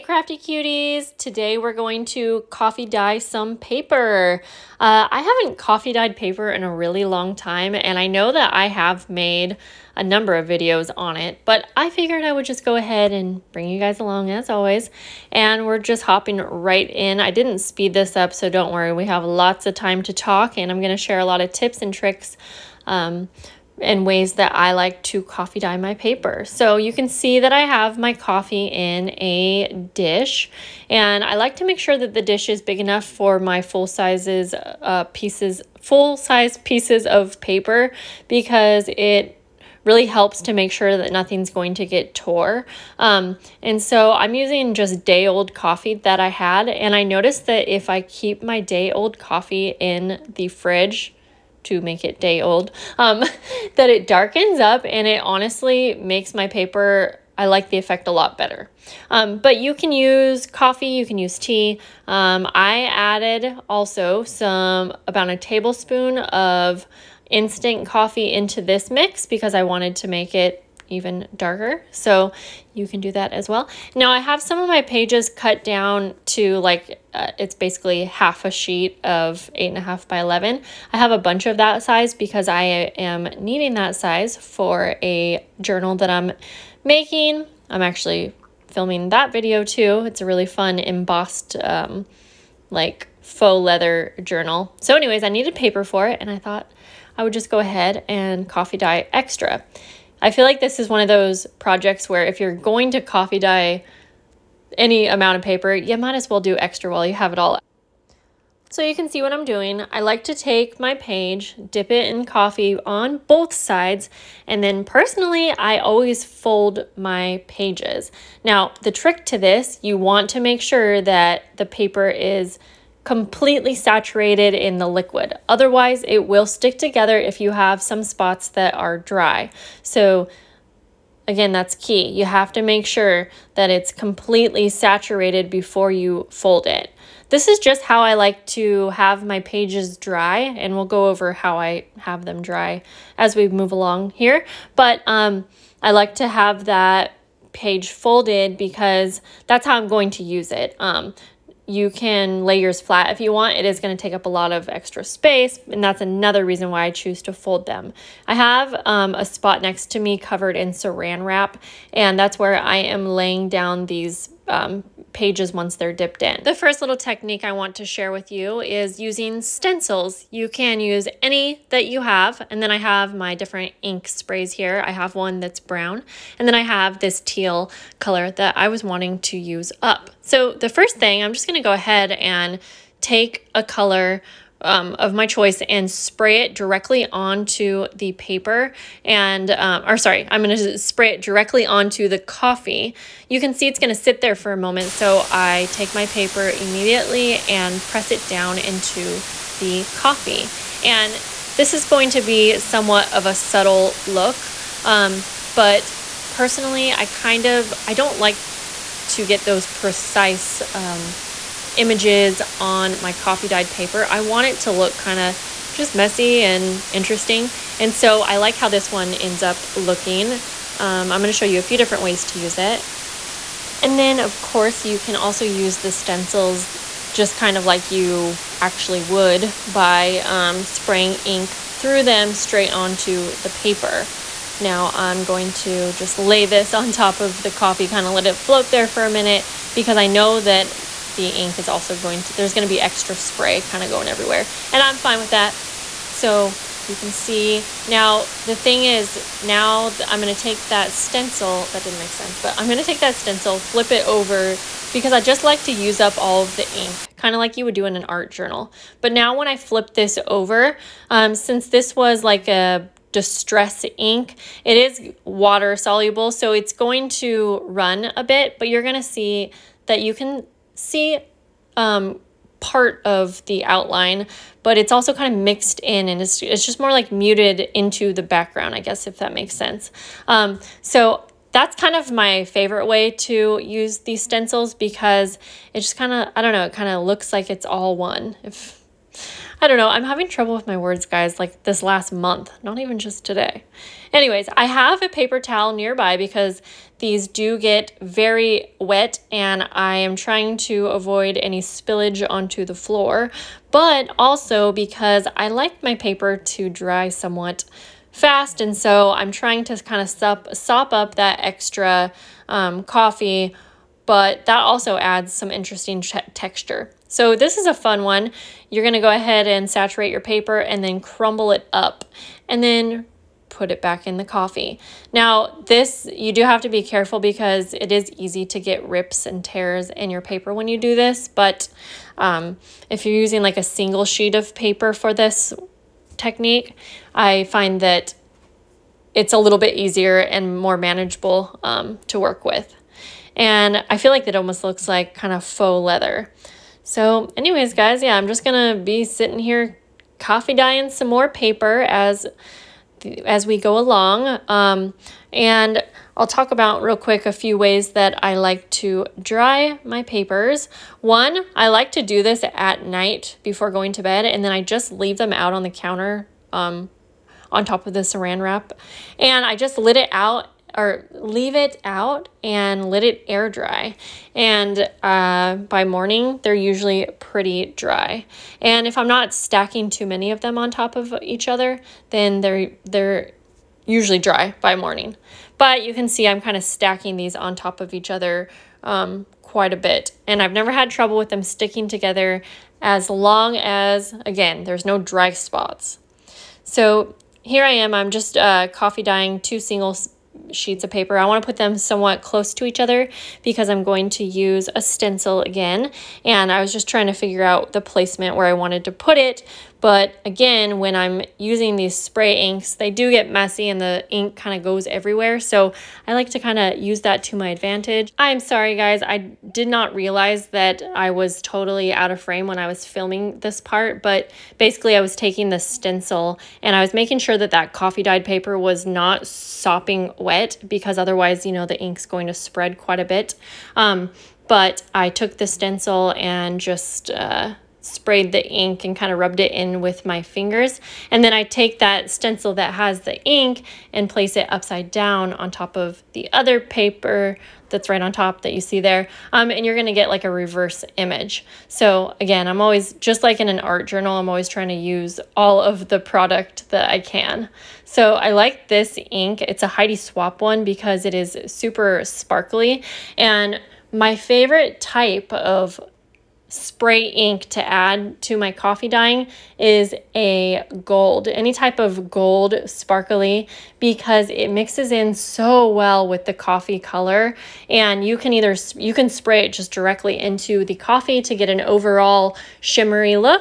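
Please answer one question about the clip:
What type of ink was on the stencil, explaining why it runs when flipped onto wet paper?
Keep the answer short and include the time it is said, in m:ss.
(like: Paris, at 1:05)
distress ink, at 4:23.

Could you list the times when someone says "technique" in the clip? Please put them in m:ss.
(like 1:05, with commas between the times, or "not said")
2:46, 5:36.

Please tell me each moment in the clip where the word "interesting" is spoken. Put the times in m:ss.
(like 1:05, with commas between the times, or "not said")
3:36, 5:15.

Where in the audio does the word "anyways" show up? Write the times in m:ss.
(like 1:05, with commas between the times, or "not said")
1:34, 4:54, 5:47.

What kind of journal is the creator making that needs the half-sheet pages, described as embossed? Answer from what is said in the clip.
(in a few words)
faux leather journal.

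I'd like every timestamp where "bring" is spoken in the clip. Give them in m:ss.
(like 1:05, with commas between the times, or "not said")
0:13.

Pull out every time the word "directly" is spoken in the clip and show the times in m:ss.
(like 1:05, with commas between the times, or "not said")
3:06, 3:11, 7:59.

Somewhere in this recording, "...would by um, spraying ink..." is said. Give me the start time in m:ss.
3:49.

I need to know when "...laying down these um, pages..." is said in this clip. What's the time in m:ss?
2:43.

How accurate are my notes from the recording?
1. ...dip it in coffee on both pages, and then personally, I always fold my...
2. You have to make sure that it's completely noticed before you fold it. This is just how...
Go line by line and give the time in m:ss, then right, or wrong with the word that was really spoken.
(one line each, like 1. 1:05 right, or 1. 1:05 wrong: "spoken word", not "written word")
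1. 1:51 wrong: "sides", not "pages"
2. 2:12 wrong: "saturated", not "noticed".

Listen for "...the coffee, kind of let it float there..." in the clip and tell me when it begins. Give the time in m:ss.
3:57.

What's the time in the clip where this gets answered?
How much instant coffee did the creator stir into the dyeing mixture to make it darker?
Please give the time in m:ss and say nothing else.
1:05.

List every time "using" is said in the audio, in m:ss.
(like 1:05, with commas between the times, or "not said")
0:44, 2:48, 5:33, 6:51.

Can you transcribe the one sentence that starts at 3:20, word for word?
And this is going to be somewhat of a subtle look.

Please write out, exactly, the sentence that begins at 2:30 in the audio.
Um, you can lay yours flat if you want.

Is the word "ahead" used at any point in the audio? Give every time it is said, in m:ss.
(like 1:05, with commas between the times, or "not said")
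0:12, 1:37, 3:01, 5:19.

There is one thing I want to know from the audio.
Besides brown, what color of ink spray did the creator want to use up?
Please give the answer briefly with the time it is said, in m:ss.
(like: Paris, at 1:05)
teal, at 2:57.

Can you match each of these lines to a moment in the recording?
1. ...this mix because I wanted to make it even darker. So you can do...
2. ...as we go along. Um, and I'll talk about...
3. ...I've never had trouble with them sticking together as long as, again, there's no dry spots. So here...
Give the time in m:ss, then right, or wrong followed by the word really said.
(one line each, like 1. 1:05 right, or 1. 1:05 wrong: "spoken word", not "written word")
1. 1:08 right
2. 5:53 right
3. 6:30 right.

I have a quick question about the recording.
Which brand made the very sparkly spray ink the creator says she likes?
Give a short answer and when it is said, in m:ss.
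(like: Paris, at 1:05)
Heidi Swapp, at 7:39.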